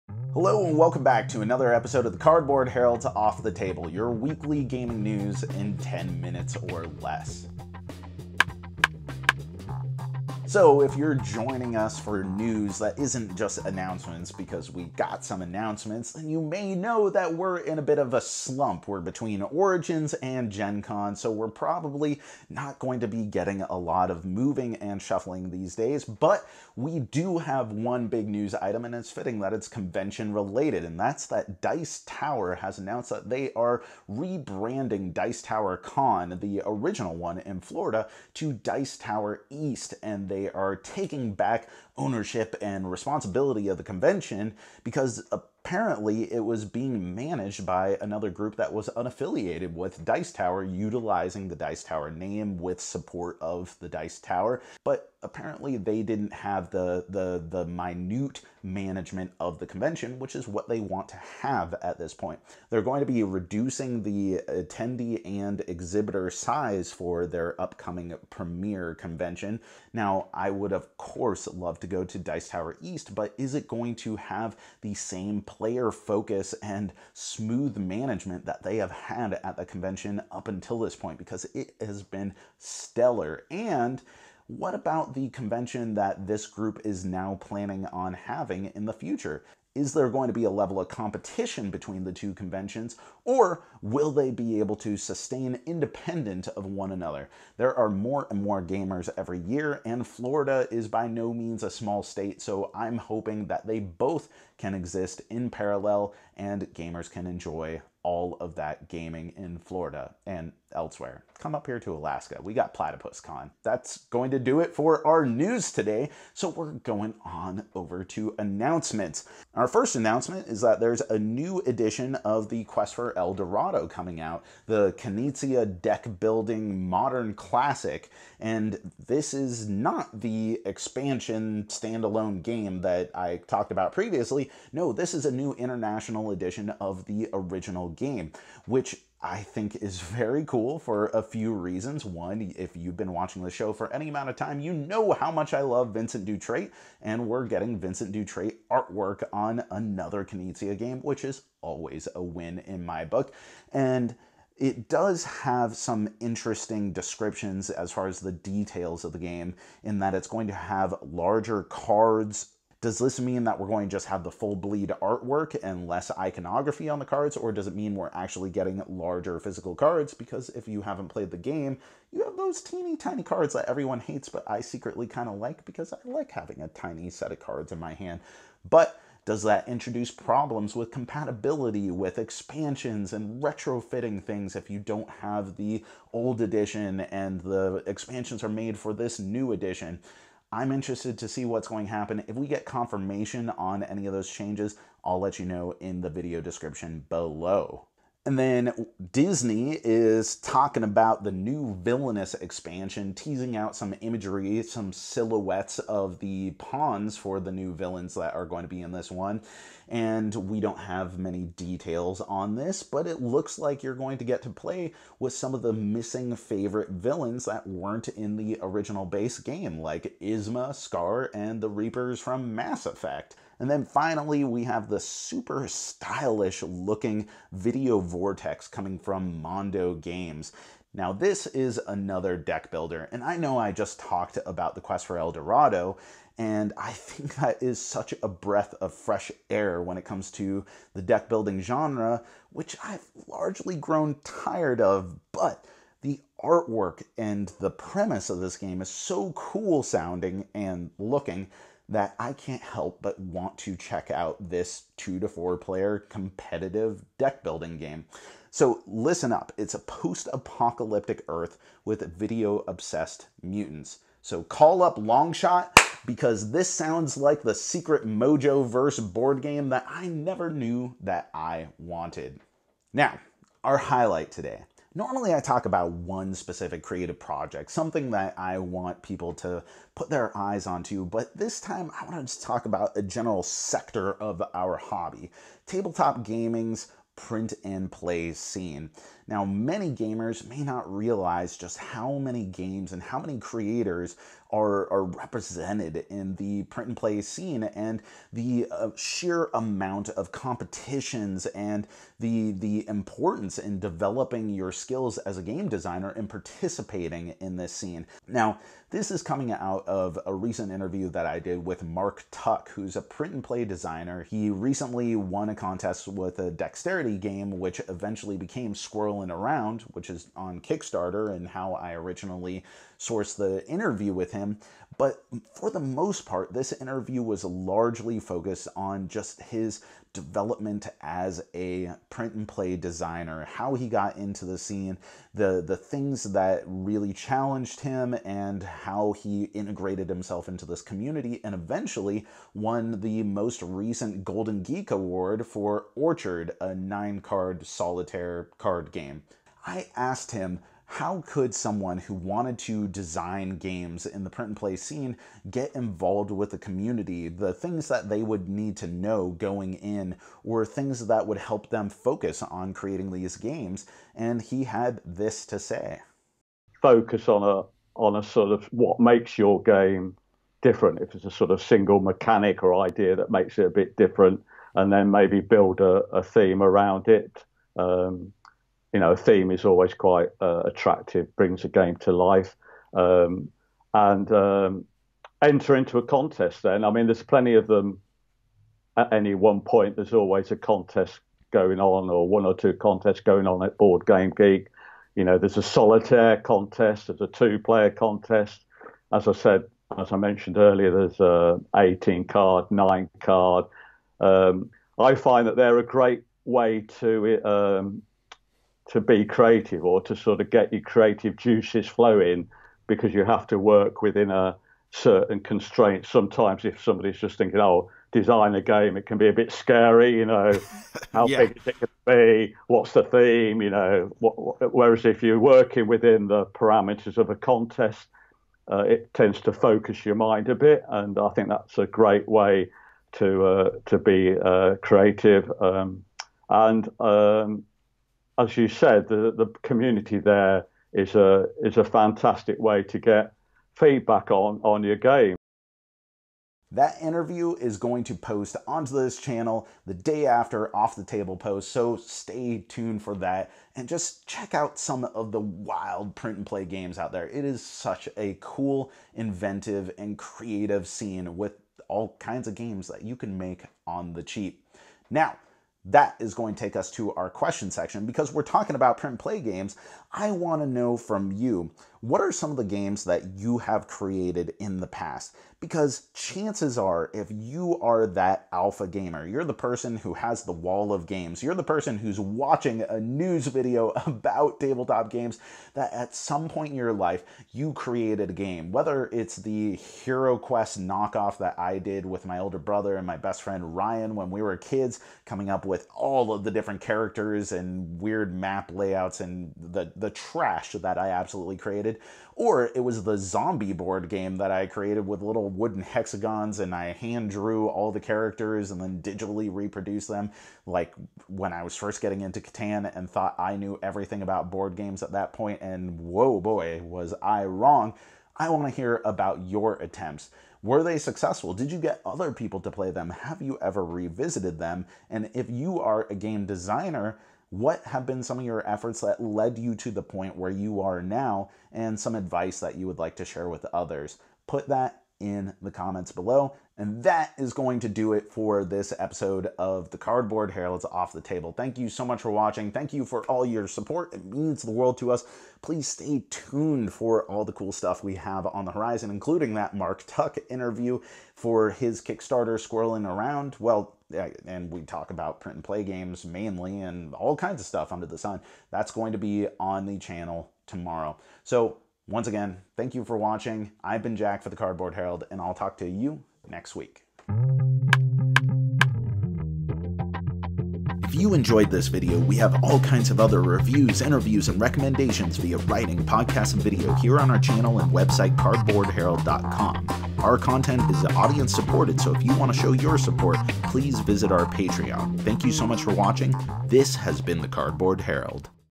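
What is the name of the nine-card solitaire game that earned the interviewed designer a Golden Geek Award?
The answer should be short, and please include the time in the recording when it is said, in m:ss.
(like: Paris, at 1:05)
Orchard, at 5:45.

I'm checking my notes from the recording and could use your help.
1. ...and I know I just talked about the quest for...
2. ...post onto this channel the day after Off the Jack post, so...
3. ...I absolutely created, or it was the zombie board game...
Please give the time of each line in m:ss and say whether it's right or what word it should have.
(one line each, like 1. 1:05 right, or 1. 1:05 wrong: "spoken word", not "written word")
1. 3:53 right
2. 7:28 wrong: "Table", not "Jack"
3. 8:20 right.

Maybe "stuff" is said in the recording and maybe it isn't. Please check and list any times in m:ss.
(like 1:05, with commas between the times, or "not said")
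9:07, 9:17.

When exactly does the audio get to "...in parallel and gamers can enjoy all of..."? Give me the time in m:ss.
1:45.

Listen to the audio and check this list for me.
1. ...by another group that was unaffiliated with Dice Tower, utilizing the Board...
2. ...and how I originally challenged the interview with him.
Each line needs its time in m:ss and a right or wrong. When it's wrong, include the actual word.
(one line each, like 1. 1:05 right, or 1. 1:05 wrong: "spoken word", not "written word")
1. 0:47 wrong: "Dice", not "Board"
2. 5:21 wrong: "sourced", not "challenged".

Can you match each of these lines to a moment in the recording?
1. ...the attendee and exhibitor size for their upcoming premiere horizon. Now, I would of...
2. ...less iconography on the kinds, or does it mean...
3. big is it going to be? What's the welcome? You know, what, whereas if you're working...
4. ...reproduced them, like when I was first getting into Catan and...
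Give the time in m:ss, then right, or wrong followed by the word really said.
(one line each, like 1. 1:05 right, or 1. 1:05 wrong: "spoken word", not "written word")
1. 1:04 wrong: "convention", not "horizon"
2. 2:45 wrong: "cards", not "kinds"
3. 7:01 wrong: "theme", not "welcome"
4. 8:29 right.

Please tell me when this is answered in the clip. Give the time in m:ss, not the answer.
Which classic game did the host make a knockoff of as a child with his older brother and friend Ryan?
8:09.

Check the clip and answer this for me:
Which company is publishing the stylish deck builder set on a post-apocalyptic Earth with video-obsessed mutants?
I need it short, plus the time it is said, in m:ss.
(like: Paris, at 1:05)
Mondo Games, at 3:49.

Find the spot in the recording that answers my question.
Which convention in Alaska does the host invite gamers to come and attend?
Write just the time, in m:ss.
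1:52.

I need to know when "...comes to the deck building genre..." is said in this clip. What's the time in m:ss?
4:00.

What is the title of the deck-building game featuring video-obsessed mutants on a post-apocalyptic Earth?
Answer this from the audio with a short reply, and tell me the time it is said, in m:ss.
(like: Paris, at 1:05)
Video Vortex, at 3:47.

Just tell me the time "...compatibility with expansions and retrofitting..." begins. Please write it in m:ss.
3:00.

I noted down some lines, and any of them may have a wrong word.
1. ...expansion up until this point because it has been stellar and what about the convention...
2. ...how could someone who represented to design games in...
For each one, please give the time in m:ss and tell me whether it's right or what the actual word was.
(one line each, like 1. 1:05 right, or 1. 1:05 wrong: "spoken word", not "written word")
1. 1:19 wrong: "convention", not "expansion"
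2. 5:50 wrong: "wanted", not "represented".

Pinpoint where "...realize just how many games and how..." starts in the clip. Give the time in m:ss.
4:50.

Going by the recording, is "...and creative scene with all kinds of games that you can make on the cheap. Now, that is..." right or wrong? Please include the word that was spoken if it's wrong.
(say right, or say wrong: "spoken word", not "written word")
right.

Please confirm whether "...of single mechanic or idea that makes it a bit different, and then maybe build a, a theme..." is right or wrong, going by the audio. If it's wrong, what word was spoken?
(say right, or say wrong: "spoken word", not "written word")
right.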